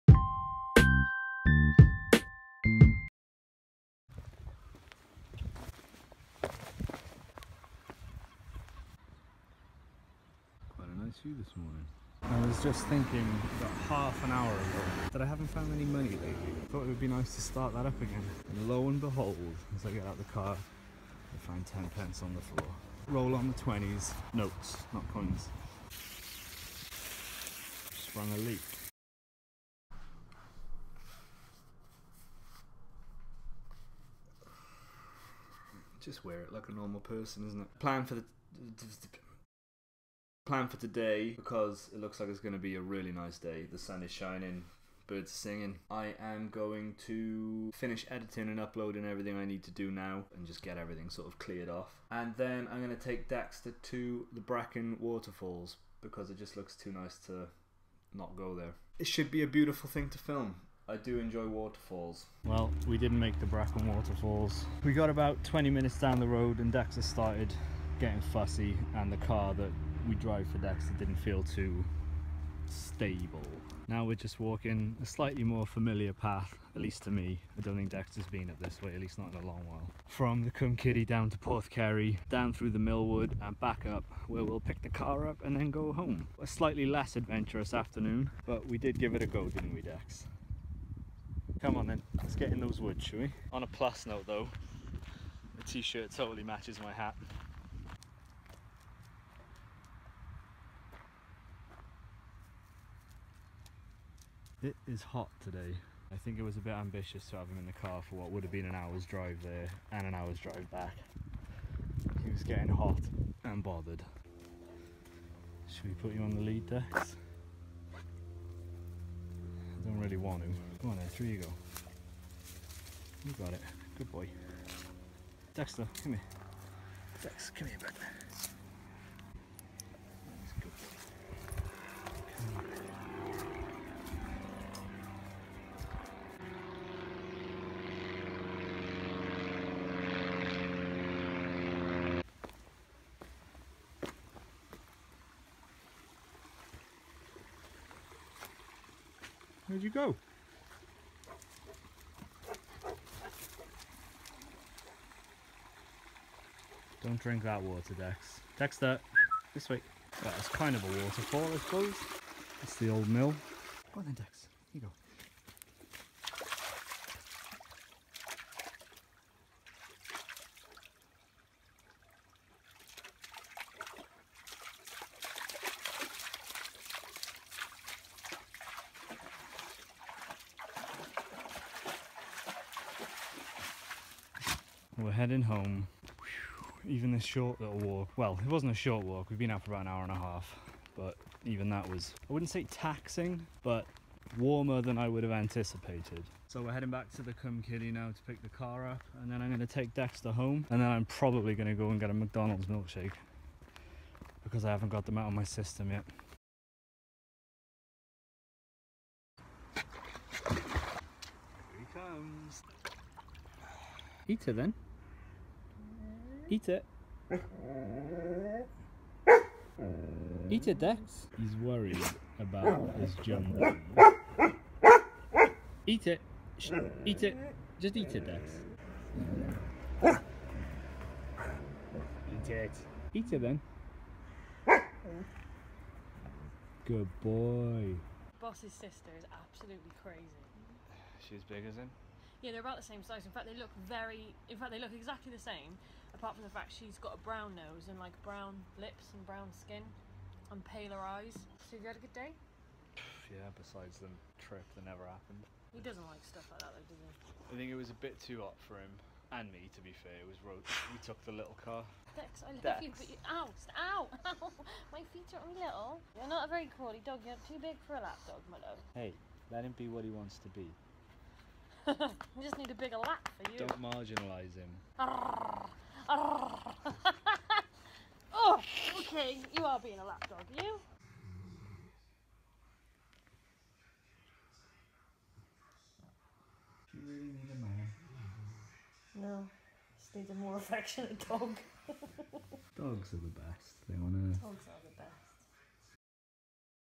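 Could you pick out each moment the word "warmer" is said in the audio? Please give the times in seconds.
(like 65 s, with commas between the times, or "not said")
194 s.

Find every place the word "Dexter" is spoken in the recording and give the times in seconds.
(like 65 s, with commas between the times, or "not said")
53 s, 66 s, 77 s, 125 s, 158 s, 199 s.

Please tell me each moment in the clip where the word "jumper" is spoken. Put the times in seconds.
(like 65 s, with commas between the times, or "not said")
223 s.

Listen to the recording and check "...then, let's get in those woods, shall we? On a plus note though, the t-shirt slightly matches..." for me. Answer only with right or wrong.
wrong.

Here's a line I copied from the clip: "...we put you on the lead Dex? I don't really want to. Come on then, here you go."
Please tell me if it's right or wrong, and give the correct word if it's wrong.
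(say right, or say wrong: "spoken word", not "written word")
right.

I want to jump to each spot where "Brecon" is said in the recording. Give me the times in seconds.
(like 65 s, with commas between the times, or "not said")
54 s, 63 s.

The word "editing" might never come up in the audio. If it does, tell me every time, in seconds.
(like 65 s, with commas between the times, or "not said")
48 s.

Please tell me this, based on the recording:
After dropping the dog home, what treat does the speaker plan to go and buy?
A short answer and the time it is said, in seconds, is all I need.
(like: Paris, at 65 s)
McDonald's milkshake, at 202 s.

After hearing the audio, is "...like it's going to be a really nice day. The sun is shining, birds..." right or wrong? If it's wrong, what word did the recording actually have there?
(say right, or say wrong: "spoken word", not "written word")
right.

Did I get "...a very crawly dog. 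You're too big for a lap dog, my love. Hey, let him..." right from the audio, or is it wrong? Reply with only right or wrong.
right.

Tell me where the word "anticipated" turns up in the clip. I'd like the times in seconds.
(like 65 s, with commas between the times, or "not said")
195 s.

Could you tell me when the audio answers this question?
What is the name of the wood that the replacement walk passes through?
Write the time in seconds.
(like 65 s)
82 s.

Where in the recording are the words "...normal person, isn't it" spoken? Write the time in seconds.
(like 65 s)
36 s.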